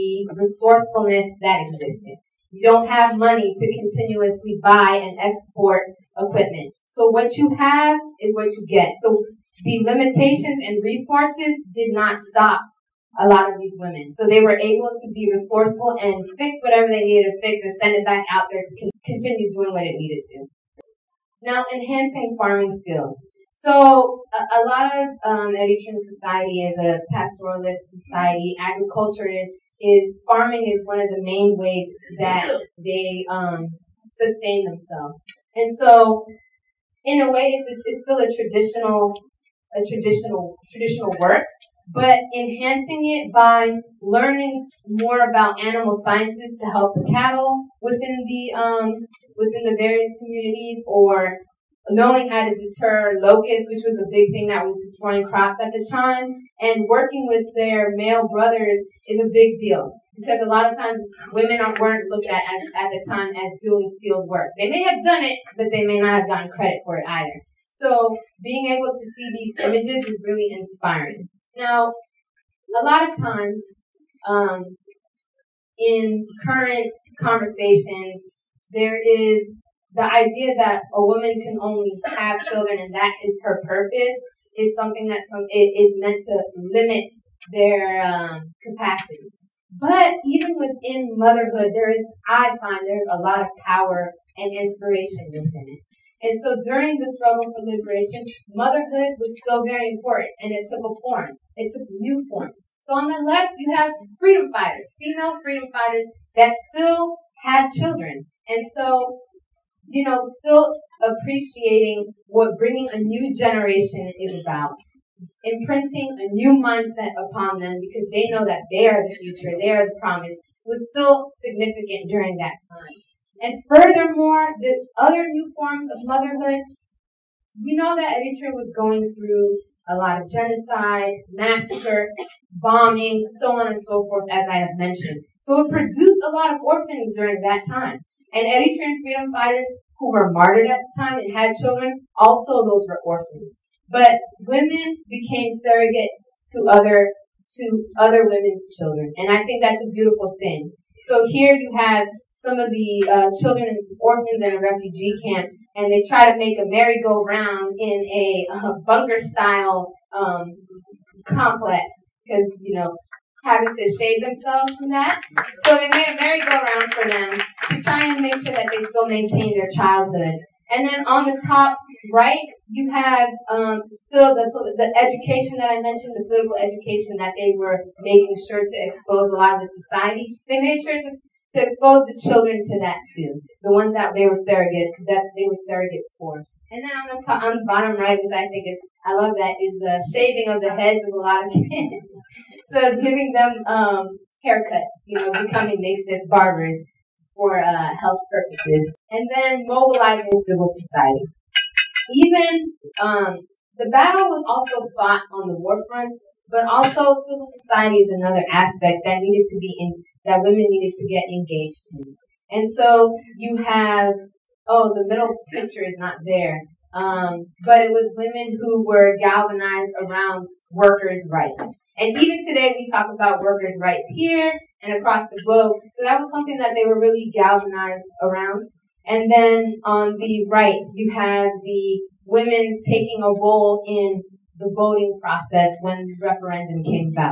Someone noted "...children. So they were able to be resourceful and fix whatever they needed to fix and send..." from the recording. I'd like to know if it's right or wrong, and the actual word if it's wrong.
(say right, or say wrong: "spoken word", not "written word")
wrong: "women", not "children".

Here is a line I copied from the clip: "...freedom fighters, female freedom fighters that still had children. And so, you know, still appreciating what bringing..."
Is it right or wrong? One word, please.
right.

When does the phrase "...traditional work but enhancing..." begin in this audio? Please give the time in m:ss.
0:40.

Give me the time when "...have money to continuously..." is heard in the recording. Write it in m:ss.
0:02.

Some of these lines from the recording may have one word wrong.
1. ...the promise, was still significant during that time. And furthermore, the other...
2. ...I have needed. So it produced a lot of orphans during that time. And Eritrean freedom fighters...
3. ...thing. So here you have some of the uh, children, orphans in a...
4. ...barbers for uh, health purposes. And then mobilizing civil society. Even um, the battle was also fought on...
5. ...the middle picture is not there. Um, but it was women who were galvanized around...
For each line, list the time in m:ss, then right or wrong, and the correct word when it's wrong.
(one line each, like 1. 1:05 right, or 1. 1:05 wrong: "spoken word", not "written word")
1. 1:59 right
2. 2:14 wrong: "mentioned", not "needed"
3. 2:30 right
4. 3:16 right
5. 3:34 right.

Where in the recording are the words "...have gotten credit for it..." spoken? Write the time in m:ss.
1:06.